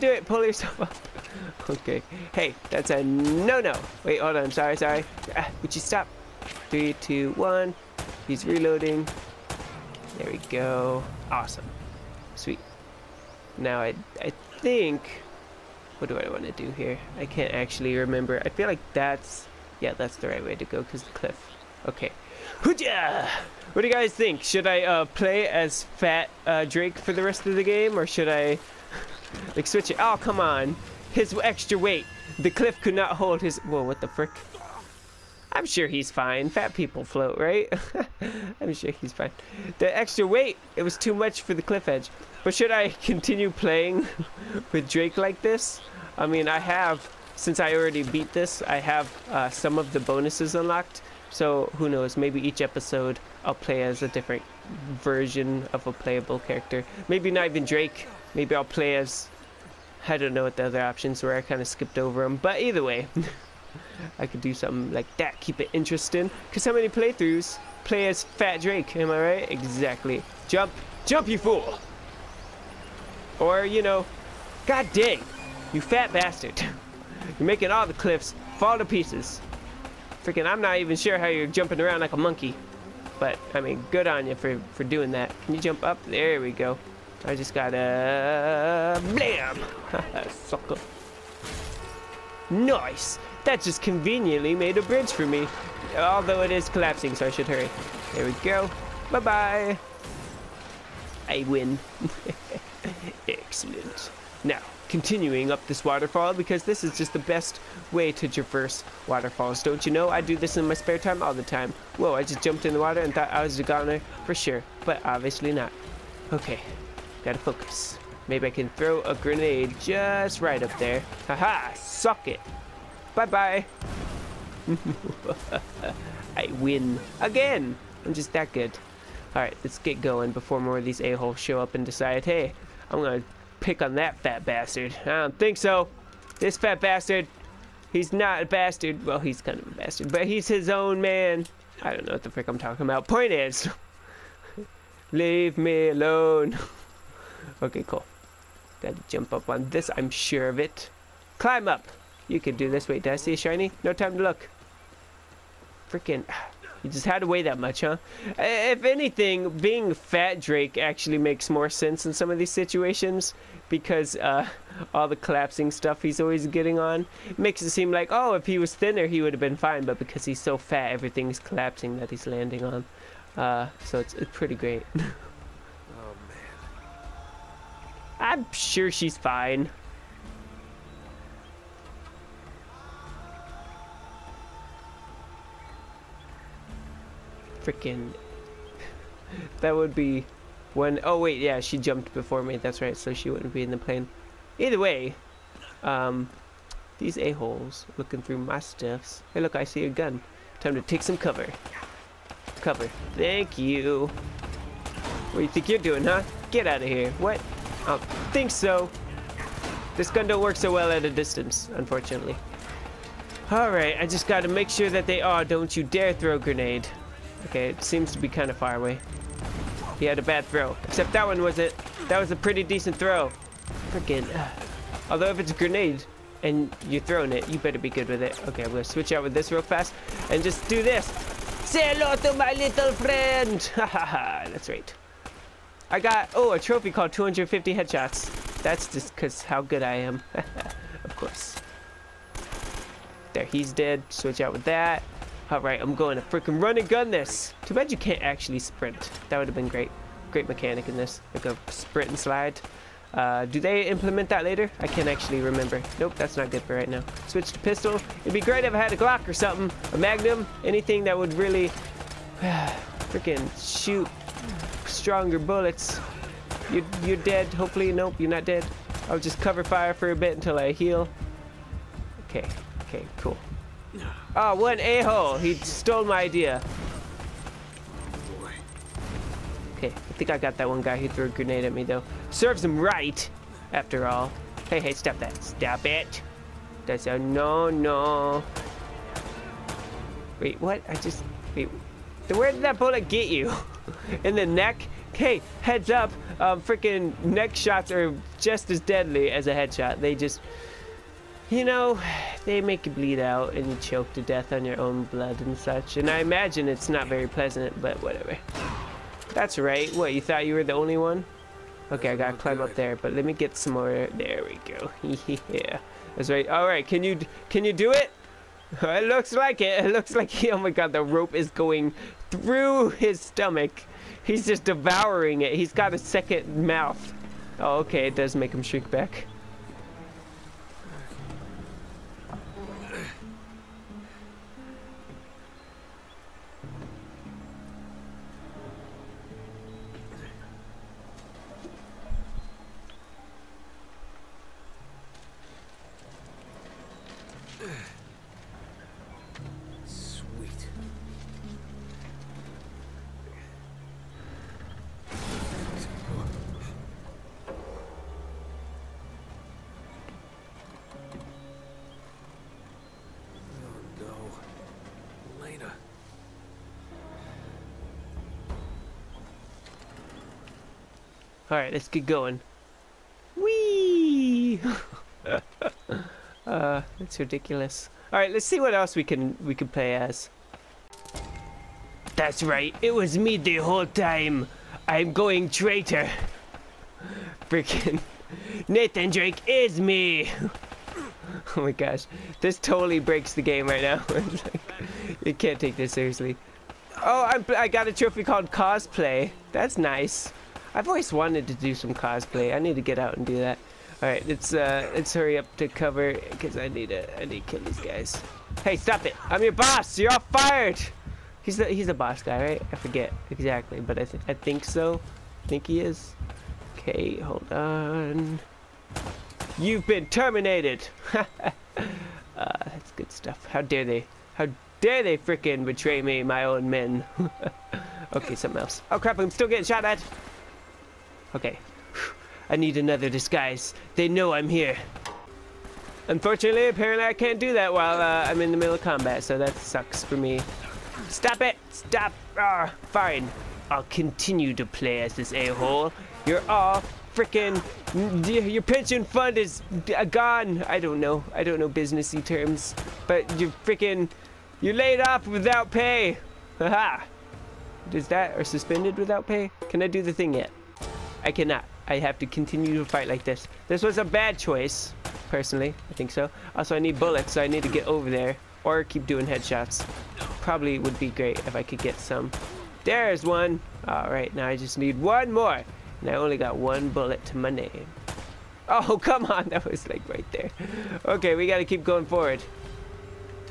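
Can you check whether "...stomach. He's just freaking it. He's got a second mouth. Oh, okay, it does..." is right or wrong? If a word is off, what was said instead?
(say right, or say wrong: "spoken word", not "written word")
wrong: "devouring", not "freaking".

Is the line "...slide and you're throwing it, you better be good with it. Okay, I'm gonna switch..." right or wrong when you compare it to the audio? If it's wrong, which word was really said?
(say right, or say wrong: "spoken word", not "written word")
wrong: "grenade", not "slide".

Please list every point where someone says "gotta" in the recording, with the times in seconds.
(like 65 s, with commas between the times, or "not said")
87 s, 117 s, 148 s, 214 s, 312 s.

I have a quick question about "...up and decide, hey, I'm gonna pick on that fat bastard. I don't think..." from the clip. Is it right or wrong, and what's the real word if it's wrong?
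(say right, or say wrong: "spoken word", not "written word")
right.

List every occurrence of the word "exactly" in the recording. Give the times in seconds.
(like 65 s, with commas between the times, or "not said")
69 s, 413 s.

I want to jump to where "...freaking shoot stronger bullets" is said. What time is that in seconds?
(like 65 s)
262 s.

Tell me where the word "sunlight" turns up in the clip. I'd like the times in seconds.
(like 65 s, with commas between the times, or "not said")
not said.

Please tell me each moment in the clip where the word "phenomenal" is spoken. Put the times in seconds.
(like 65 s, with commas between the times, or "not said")
not said.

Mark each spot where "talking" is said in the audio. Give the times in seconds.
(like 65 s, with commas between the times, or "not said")
142 s.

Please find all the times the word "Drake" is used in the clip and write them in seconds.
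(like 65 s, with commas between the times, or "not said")
26 s, 44 s, 57 s, 68 s, 160 s, 389 s.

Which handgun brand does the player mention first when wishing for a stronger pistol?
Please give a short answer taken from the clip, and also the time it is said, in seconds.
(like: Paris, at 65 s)
Glock, at 258 s.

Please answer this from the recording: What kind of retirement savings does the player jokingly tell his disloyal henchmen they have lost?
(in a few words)
Pension fund.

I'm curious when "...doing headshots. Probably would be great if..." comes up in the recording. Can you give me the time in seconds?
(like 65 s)
469 s.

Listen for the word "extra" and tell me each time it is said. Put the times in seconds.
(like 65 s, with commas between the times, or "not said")
31 s, 39 s.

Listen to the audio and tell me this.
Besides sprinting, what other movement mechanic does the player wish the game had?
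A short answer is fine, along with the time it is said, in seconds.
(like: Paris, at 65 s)
Slide, at 252 s.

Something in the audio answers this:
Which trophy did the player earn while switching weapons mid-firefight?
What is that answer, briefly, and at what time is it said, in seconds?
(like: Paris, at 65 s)
250 headshots, at 237 s.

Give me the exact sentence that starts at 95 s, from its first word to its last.
Although it is collapsing, so I should hurry.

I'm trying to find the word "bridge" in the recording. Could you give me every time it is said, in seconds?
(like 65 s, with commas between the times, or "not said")
94 s.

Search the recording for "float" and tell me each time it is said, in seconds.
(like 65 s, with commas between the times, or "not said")
37 s.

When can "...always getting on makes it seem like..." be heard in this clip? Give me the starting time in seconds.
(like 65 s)
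166 s.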